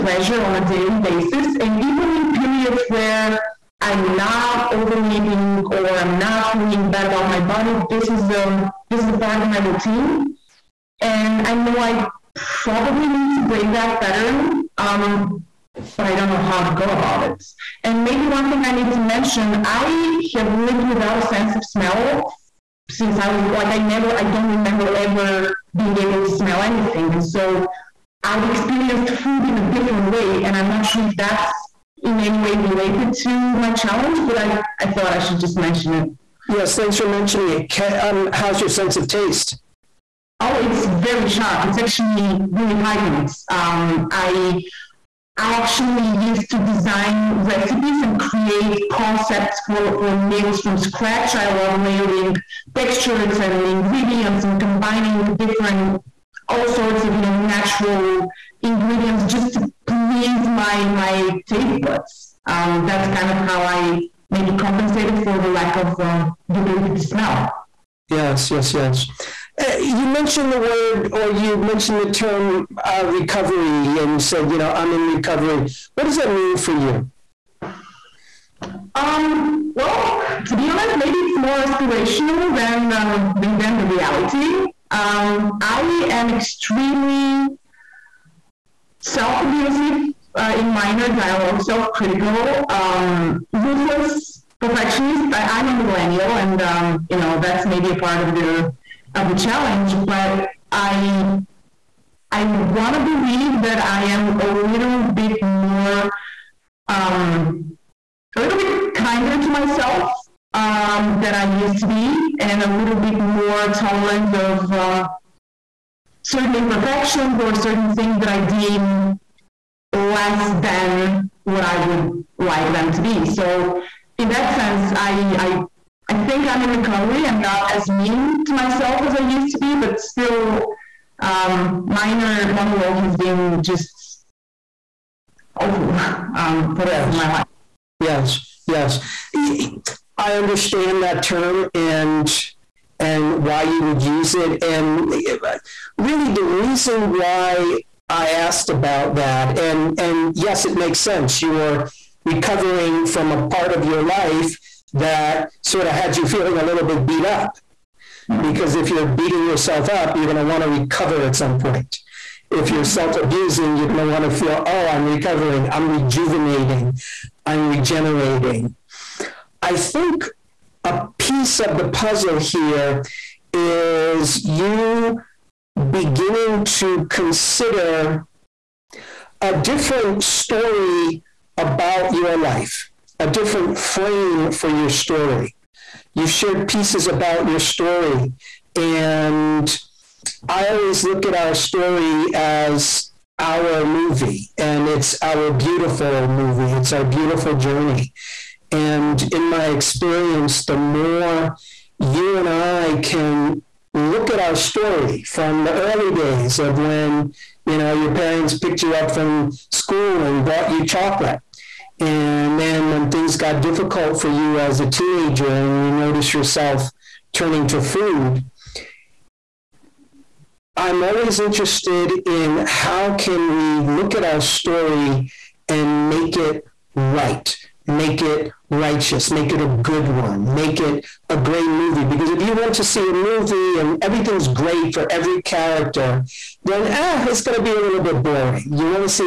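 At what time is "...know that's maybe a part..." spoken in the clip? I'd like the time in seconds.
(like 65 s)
97 s.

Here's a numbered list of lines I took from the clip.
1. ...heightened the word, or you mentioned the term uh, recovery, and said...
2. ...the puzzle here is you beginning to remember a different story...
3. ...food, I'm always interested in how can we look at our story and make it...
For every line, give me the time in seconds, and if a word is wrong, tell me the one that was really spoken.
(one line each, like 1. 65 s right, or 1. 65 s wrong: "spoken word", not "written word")
1. 70 s wrong: "mentioned", not "heightened"
2. 171 s wrong: "consider", not "remember"
3. 217 s right.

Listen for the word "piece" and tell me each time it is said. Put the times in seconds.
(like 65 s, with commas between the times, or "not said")
171 s, 186 s.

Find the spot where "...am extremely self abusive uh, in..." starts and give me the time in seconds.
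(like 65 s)
86 s.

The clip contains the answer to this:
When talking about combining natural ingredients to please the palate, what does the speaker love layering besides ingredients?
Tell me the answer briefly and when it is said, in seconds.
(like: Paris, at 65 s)
textures, at 52 s.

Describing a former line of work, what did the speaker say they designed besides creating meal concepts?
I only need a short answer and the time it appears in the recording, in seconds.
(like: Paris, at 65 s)
recipes, at 47 s.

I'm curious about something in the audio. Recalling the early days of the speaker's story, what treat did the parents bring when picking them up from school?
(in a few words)
chocolate.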